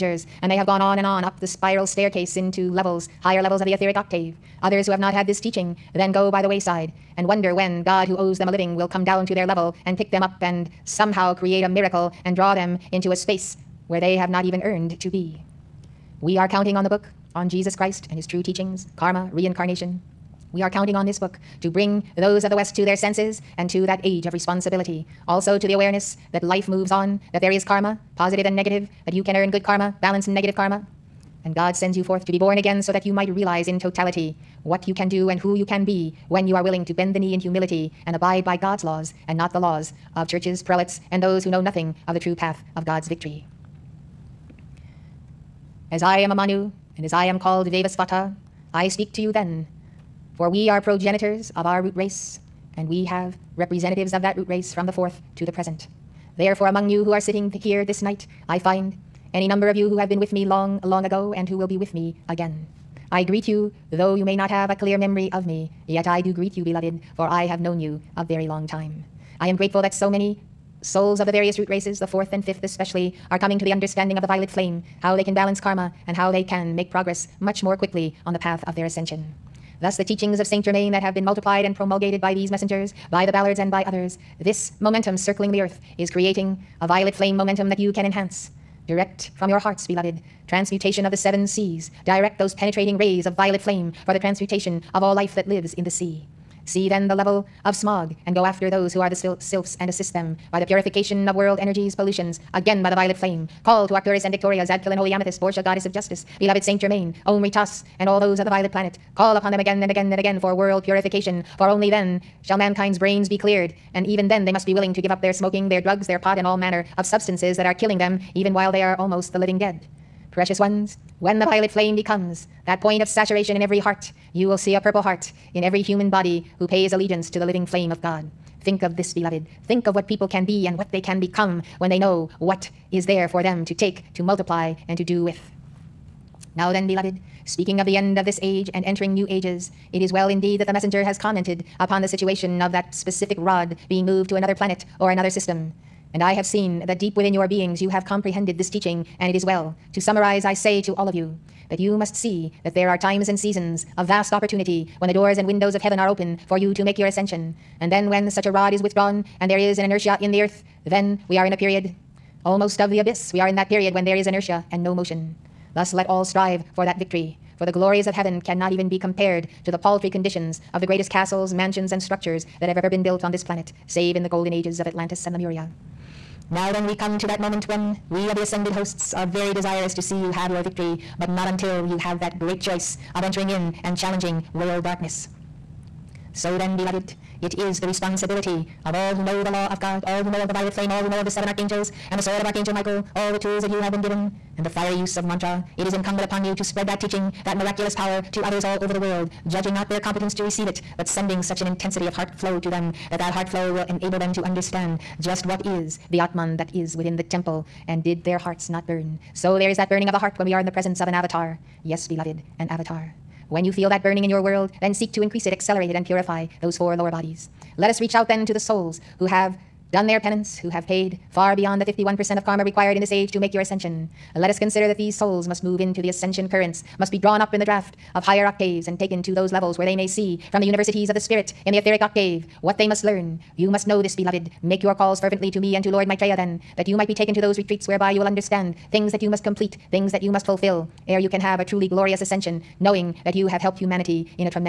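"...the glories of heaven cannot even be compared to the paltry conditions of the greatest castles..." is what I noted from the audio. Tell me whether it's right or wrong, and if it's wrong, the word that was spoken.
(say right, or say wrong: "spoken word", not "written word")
right.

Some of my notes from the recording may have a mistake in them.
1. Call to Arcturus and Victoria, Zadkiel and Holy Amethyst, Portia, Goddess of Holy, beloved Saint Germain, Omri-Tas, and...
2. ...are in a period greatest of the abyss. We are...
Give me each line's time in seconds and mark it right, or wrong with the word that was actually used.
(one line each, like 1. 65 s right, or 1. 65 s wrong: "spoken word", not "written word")
1. 103 s wrong: "Justice", not "Holy"
2. 161 s wrong: "almost", not "greatest".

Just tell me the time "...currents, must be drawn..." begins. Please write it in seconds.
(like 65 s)
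226 s.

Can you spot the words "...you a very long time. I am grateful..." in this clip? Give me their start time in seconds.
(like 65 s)
67 s.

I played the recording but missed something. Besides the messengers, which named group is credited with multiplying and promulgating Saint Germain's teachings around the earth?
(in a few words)
the Ballards.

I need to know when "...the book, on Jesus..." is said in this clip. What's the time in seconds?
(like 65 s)
16 s.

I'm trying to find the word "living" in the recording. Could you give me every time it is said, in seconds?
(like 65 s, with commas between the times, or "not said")
8 s, 119 s, 127 s.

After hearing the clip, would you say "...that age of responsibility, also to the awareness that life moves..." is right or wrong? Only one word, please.
right.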